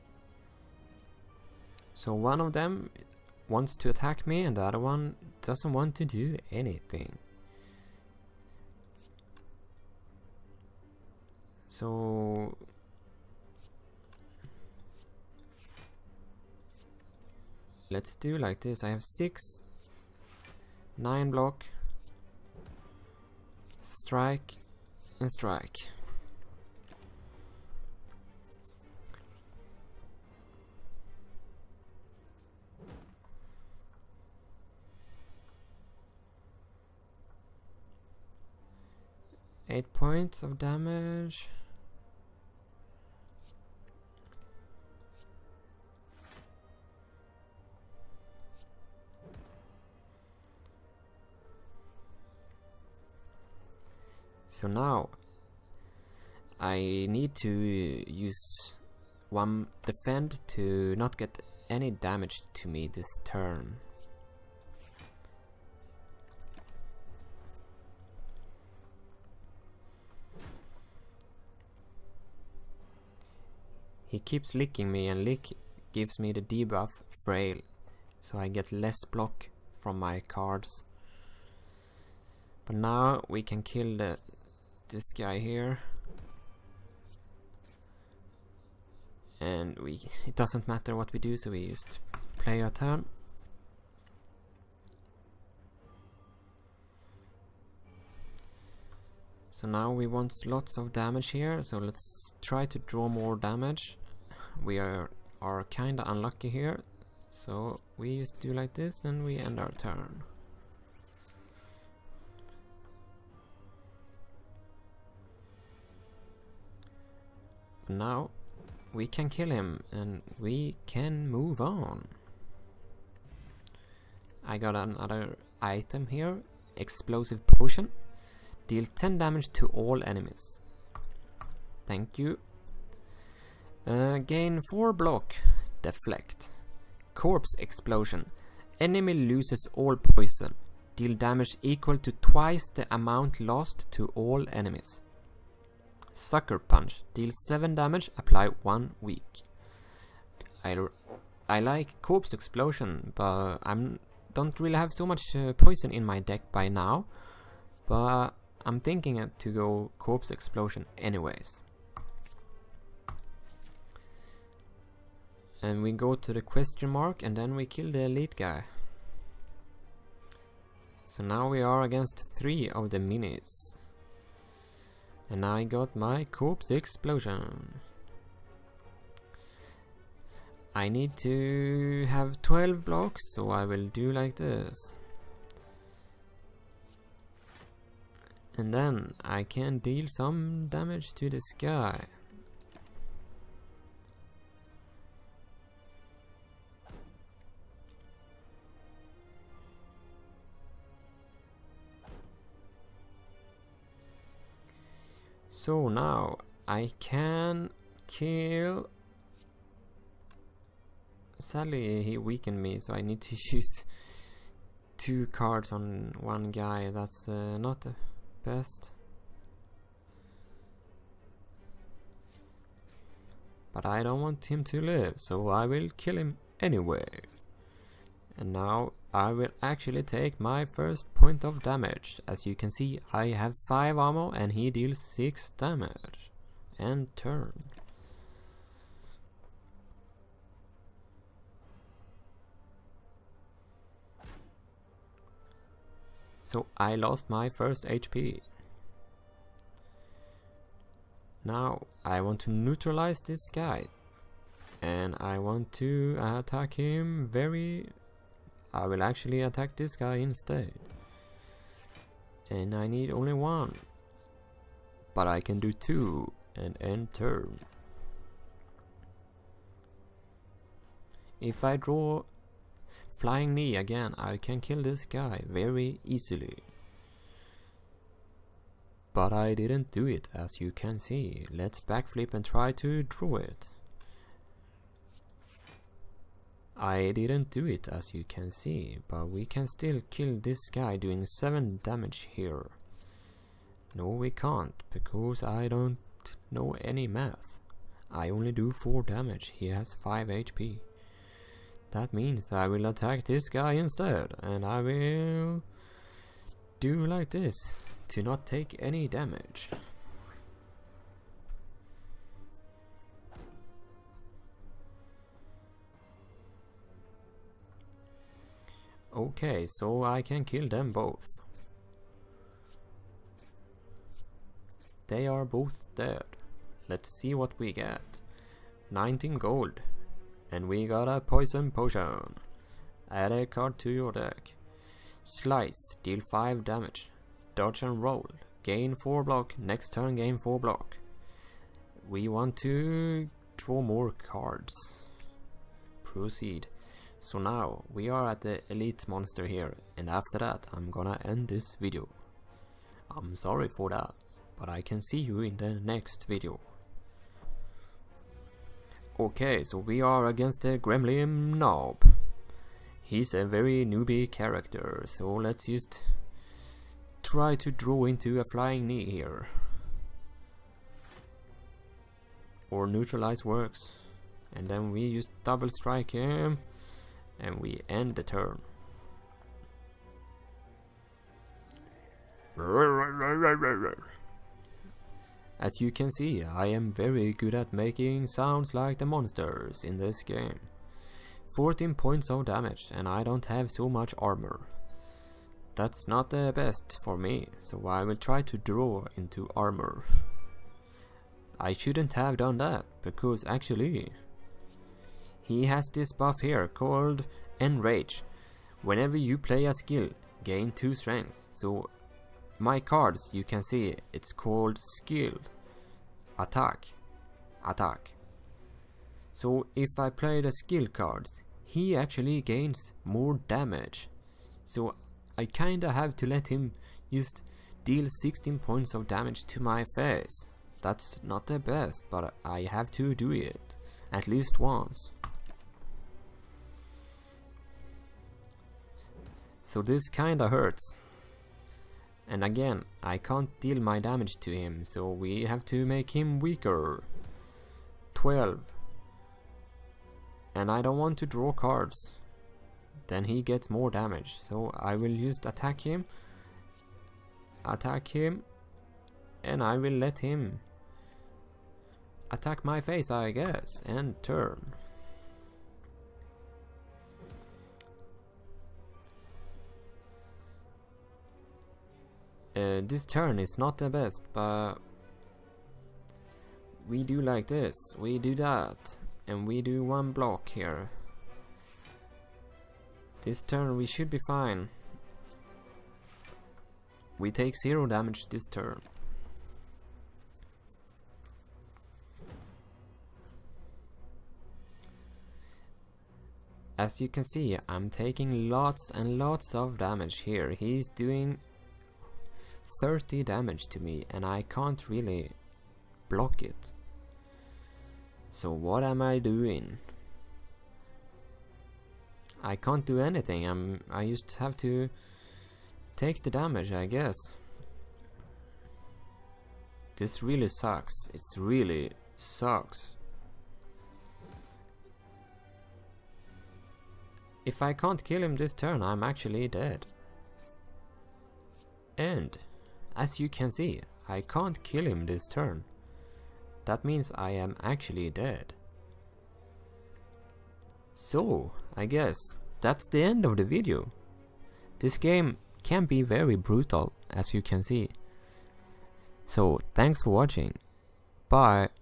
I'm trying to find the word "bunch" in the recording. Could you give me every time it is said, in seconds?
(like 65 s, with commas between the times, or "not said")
not said.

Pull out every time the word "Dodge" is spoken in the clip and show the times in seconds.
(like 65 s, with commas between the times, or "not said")
337 s.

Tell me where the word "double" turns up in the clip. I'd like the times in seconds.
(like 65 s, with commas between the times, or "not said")
375 s.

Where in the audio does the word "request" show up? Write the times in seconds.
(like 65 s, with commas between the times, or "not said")
not said.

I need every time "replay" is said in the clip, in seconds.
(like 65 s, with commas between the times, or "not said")
not said.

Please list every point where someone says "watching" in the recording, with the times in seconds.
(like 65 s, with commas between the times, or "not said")
550 s.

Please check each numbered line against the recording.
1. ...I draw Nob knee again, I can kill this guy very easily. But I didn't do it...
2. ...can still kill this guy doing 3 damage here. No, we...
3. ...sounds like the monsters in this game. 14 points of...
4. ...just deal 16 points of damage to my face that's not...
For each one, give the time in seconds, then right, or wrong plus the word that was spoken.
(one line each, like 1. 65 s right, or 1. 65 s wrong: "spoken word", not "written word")
1. 271 s wrong: "Flying", not "Nob"
2. 289 s wrong: "7", not "3"
3. 388 s right
4. 427 s right.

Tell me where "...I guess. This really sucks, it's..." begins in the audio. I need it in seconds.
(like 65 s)
516 s.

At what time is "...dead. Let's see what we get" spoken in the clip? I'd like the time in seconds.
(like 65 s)
325 s.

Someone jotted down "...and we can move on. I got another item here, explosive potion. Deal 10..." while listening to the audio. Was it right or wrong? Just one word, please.
right.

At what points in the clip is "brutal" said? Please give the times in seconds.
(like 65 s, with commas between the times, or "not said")
546 s.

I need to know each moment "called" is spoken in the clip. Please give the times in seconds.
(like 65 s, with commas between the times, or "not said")
406 s, 414 s.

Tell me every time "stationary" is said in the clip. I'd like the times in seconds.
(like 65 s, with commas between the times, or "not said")
not said.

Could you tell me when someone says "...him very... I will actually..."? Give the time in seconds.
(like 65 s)
256 s.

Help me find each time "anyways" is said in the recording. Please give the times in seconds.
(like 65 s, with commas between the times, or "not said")
160 s, 226 s.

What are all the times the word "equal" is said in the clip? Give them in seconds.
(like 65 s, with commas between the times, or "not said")
141 s.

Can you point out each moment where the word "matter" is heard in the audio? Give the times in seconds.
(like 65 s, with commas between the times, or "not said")
90 s.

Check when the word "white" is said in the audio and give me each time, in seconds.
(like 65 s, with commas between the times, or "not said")
not said.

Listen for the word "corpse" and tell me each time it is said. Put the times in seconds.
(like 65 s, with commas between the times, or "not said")
137 s, 152 s, 159 s, 176 s.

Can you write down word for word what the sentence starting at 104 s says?
We are, are kinda unlucky here, so we just do like this and we end our turn.